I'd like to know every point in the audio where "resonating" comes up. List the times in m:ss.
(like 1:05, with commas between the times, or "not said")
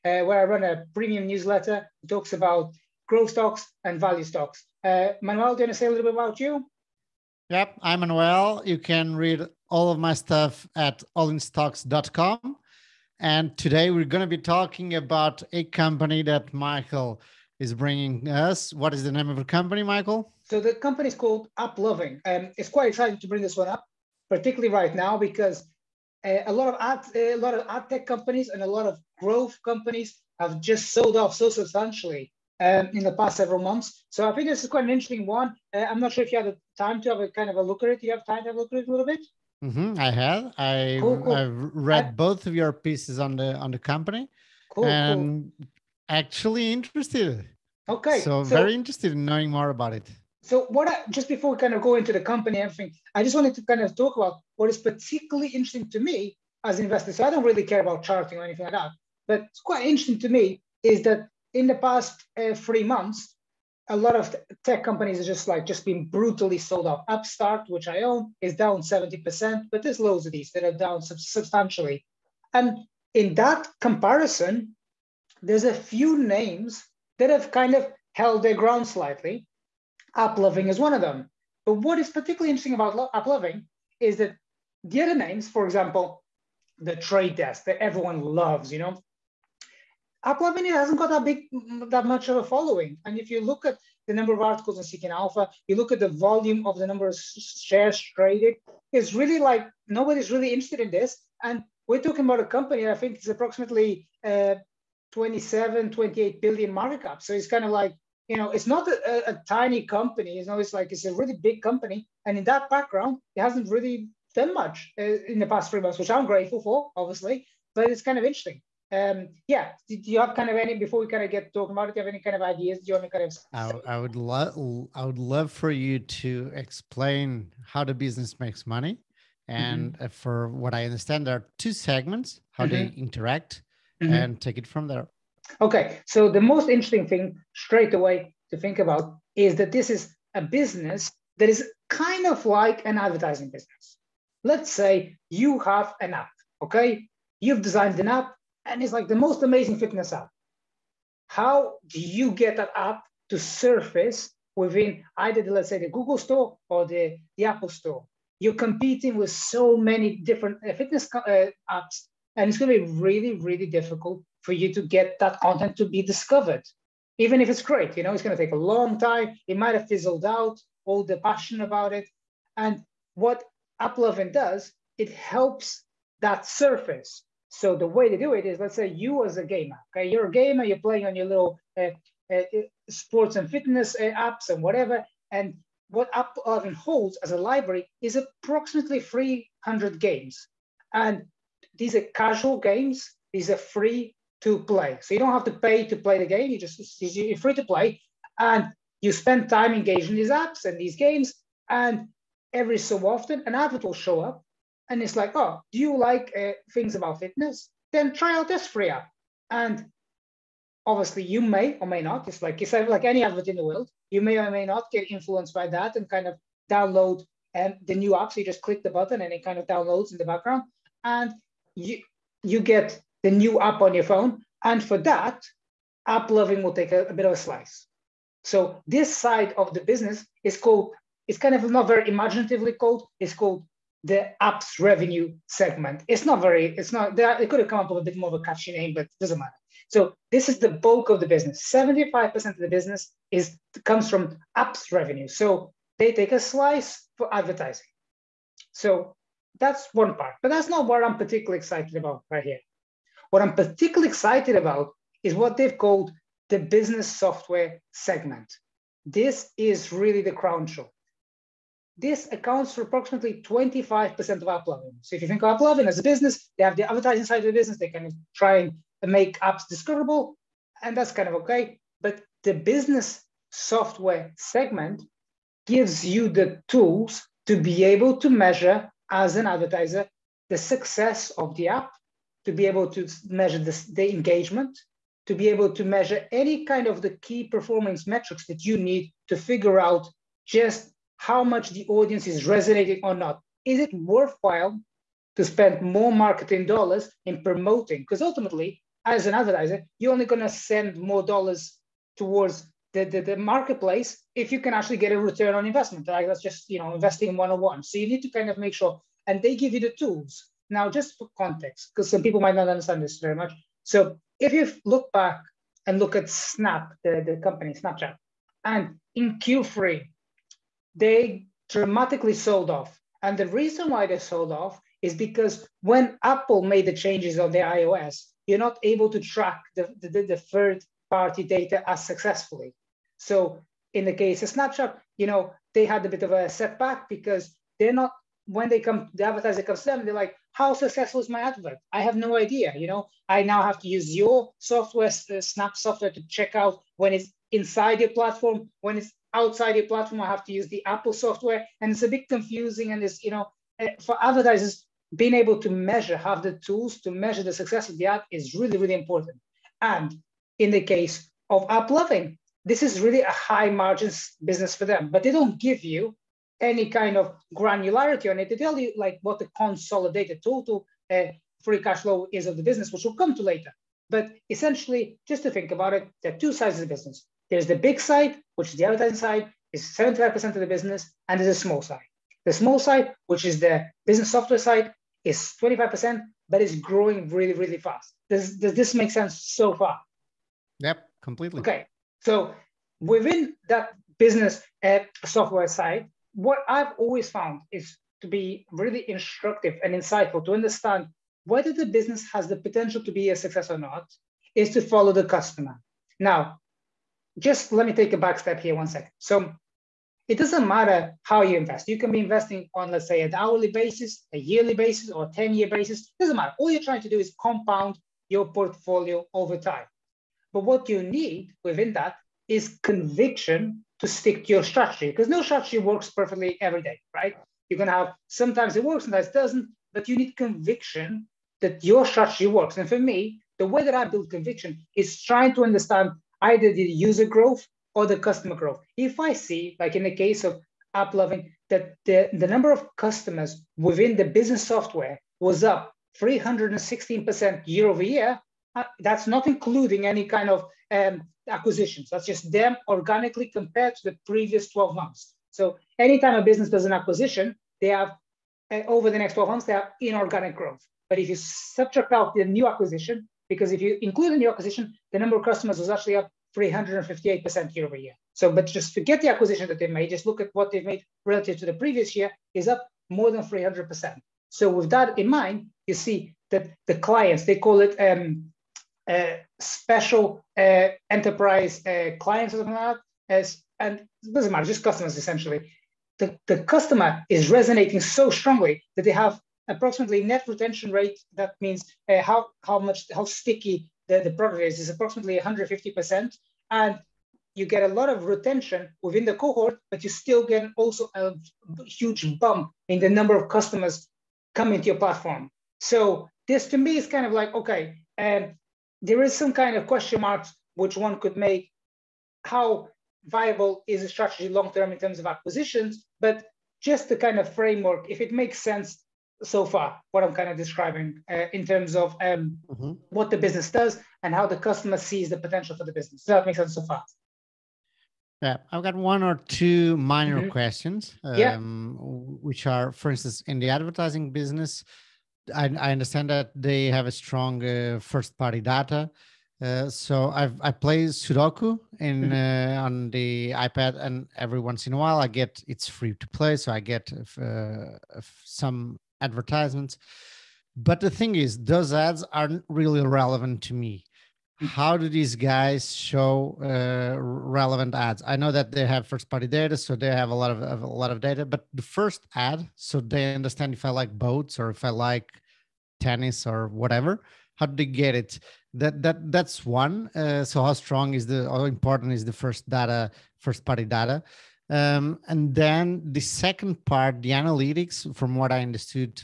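4:52, 8:07.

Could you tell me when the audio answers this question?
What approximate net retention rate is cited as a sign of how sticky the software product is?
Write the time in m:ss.
8:15.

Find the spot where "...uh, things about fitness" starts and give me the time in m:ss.
3:26.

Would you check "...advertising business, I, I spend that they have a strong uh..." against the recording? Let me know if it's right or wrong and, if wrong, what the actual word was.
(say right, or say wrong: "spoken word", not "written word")
wrong: "understand", not "spend".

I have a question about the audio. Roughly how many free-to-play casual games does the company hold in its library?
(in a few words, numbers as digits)
300.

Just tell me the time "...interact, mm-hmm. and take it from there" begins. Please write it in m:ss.
2:13.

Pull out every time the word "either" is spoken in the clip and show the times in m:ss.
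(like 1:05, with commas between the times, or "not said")
2:35, 7:16.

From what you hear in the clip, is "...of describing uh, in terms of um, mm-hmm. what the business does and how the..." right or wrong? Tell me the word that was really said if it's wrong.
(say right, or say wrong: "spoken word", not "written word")
right.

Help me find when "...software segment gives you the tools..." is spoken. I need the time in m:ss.
4:33.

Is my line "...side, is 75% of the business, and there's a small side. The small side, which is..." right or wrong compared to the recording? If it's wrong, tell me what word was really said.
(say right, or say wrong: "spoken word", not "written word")
right.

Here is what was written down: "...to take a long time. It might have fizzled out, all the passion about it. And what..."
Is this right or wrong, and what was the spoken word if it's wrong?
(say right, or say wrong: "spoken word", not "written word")
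right.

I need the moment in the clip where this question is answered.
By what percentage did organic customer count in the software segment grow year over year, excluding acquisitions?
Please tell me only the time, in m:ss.
7:26.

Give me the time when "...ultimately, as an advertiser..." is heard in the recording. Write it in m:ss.
4:58.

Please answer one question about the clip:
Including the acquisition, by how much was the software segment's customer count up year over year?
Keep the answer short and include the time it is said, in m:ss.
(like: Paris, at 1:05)
358%, at 7:46.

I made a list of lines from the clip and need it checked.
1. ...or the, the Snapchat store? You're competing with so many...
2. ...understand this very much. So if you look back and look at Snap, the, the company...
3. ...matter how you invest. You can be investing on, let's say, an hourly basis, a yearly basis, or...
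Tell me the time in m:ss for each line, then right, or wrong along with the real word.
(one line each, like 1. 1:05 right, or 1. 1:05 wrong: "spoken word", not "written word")
1. 2:36 wrong: "Apple", not "Snapchat"
2. 5:12 right
3. 6:50 right.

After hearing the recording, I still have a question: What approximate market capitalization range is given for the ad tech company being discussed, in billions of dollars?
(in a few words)
27-28 billion.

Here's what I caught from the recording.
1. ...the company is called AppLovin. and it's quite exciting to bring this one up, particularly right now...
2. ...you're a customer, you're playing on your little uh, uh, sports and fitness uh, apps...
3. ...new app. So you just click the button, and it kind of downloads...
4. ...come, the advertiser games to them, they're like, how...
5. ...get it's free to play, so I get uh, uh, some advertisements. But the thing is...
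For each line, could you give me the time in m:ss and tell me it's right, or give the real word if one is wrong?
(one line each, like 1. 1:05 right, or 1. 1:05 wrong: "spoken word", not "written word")
1. 0:20 right
2. 3:00 wrong: "gamer", not "customer"
3. 3:37 right
4. 5:38 wrong: "comes", not "games"
5. 9:05 right.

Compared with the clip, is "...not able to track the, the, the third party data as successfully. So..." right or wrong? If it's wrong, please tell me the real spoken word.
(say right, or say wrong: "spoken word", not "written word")
right.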